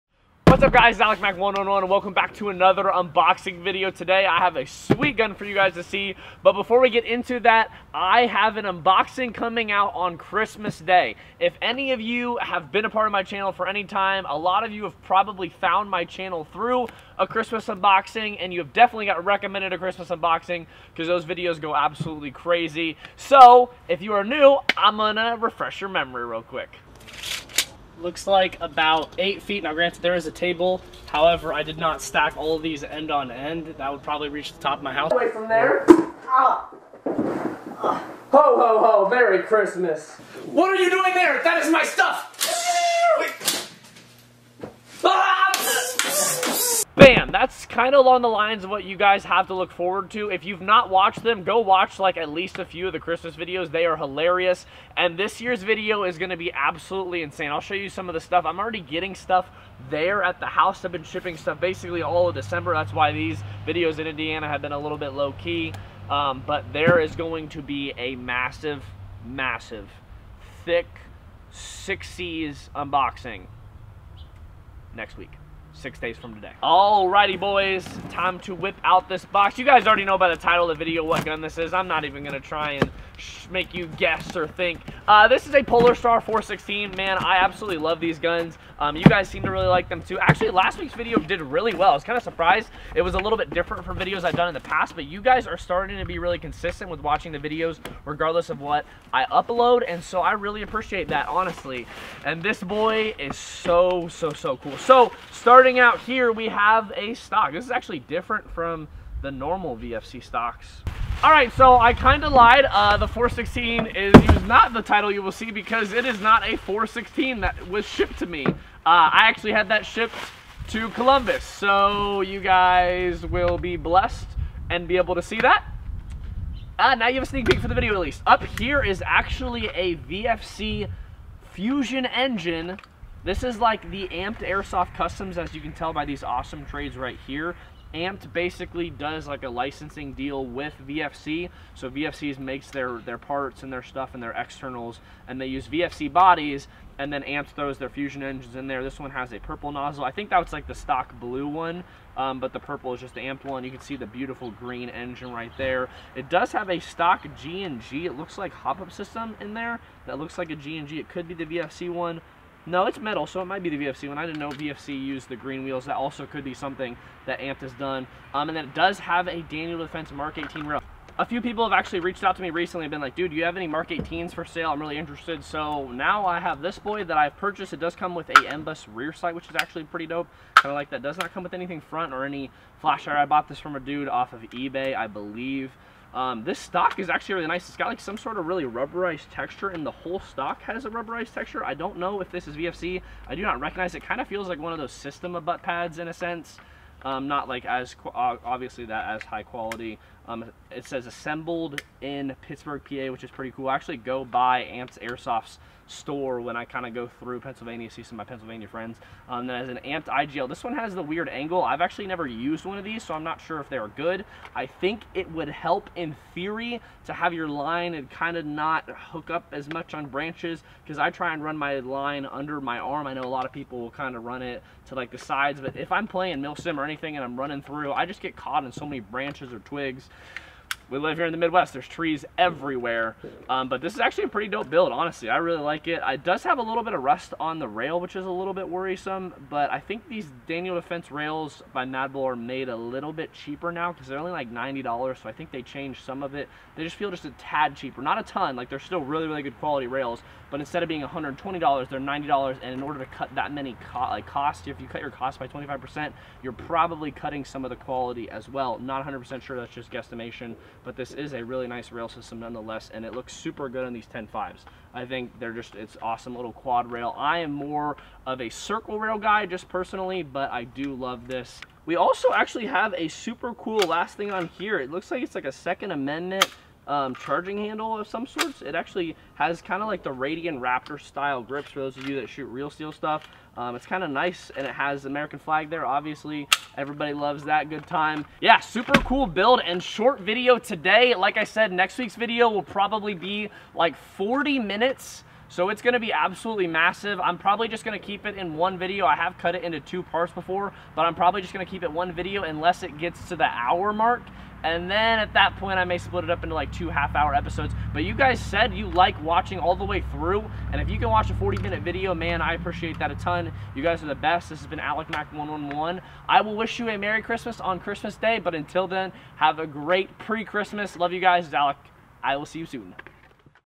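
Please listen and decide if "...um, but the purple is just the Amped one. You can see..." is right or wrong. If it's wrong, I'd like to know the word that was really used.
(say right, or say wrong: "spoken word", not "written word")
right.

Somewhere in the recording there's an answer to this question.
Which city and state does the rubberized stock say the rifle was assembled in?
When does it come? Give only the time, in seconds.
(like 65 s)
202 s.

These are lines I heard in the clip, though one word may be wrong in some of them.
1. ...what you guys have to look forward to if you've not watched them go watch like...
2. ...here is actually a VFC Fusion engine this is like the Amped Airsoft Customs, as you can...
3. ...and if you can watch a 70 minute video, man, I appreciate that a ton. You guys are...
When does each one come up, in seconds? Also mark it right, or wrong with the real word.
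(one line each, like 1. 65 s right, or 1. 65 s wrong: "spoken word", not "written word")
1. 48 s right
2. 128 s right
3. 310 s wrong: "40", not "70".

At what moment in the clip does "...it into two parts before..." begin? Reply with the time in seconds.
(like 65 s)
299 s.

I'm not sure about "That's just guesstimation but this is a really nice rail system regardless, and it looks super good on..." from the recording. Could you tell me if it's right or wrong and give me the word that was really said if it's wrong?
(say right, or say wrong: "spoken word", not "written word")
wrong: "nonetheless", not "regardless".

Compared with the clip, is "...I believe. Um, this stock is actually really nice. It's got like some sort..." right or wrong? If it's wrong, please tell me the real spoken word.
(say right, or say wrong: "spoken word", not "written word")
right.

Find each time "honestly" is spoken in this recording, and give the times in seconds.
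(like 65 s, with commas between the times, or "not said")
101 s, 234 s.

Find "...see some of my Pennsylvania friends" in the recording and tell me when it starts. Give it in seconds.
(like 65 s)
207 s.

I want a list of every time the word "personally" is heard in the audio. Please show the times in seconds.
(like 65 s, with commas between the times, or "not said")
269 s.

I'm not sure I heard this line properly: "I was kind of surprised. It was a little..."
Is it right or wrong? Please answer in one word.
right.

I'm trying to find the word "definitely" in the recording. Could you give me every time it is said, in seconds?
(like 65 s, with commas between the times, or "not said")
18 s.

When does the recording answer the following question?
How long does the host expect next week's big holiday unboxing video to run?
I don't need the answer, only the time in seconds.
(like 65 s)
294 s.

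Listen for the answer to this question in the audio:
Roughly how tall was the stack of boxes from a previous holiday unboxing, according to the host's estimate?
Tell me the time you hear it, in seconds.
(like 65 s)
28 s.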